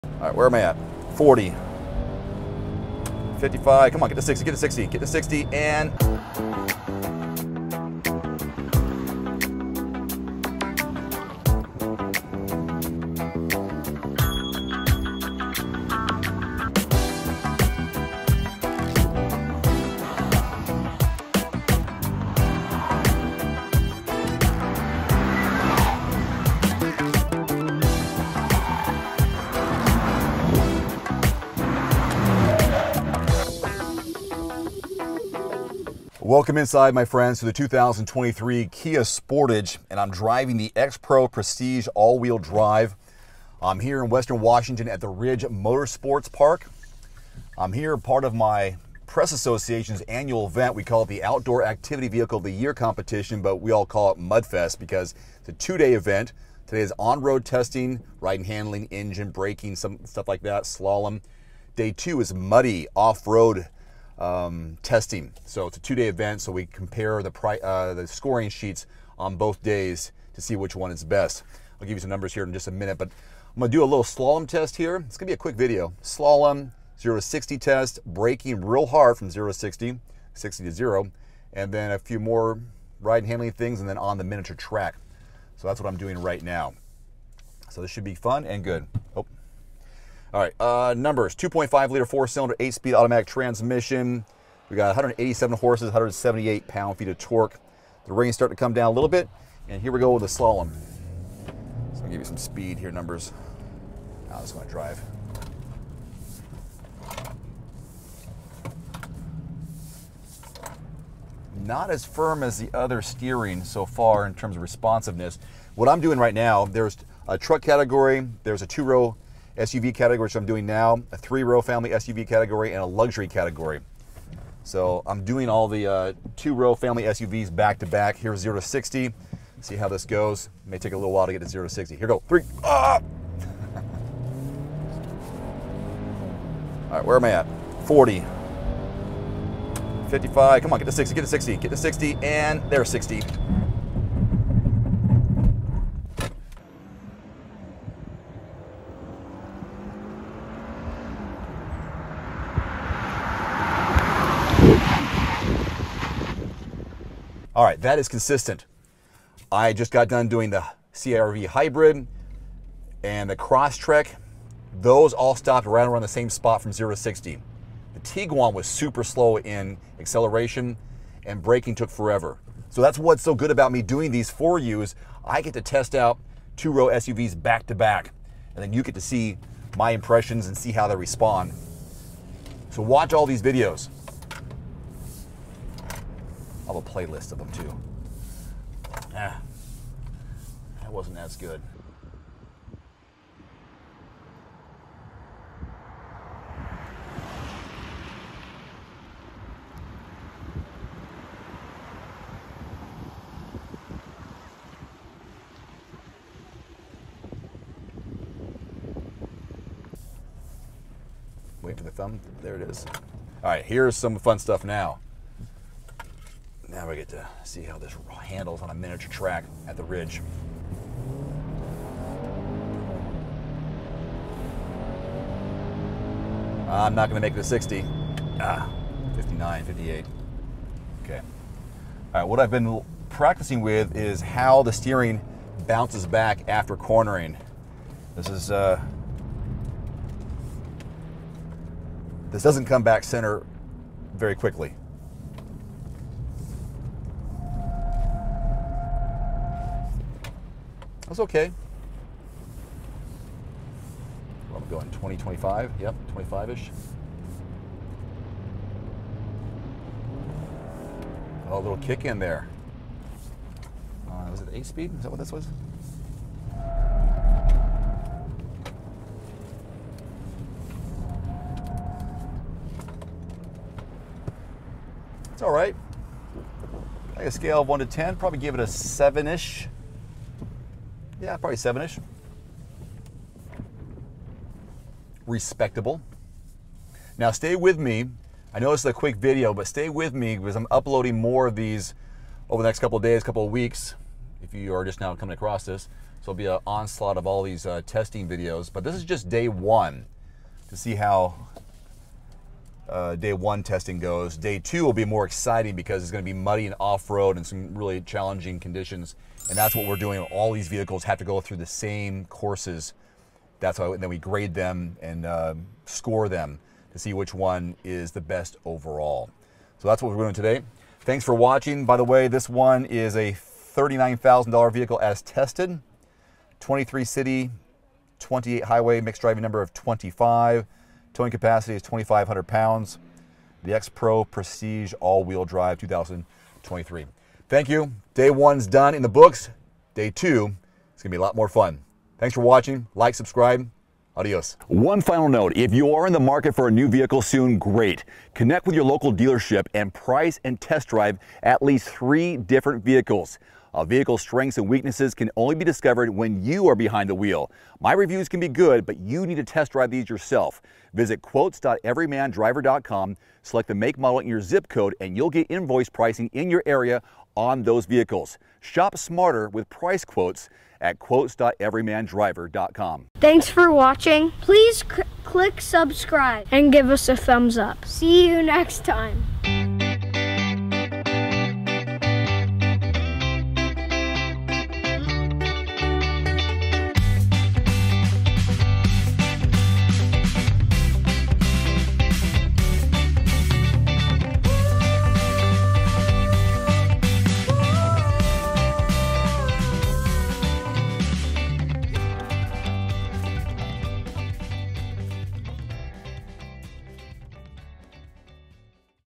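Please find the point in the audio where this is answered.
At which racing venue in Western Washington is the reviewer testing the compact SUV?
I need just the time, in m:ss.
0:45.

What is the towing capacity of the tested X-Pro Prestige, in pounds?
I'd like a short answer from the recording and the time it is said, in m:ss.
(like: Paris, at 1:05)
2,500, at 5:31.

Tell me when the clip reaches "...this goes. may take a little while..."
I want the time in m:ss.
2:09.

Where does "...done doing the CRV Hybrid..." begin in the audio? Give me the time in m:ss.
2:40.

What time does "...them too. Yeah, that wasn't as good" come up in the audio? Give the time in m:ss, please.
3:07.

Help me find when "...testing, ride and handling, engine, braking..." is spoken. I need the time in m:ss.
0:57.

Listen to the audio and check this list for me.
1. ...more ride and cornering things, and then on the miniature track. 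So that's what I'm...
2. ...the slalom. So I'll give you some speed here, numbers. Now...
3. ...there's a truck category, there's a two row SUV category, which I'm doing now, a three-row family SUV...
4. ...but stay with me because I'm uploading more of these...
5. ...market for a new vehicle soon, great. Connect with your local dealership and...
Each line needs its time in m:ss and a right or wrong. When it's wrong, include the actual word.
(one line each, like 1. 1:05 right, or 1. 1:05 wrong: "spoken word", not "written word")
1. 1:22 wrong: "handling", not "cornering"
2. 1:40 right
3. 1:56 right
4. 4:49 right
5. 5:46 right.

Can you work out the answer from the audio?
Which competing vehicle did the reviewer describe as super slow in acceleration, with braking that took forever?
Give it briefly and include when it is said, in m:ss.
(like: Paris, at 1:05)
Tiguan, at 2:47.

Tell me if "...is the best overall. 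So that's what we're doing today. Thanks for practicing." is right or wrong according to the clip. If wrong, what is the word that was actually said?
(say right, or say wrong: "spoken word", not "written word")
wrong: "watching", not "practicing".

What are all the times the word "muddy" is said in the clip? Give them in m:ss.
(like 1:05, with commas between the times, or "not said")
1:02, 5:06.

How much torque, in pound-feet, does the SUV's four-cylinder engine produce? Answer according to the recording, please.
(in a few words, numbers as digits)
178.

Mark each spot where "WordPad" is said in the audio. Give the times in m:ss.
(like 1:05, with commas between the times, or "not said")
not said.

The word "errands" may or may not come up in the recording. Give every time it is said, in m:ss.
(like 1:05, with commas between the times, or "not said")
not said.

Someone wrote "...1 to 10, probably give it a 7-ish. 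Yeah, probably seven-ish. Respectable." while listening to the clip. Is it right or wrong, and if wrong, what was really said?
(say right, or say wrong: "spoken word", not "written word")
right.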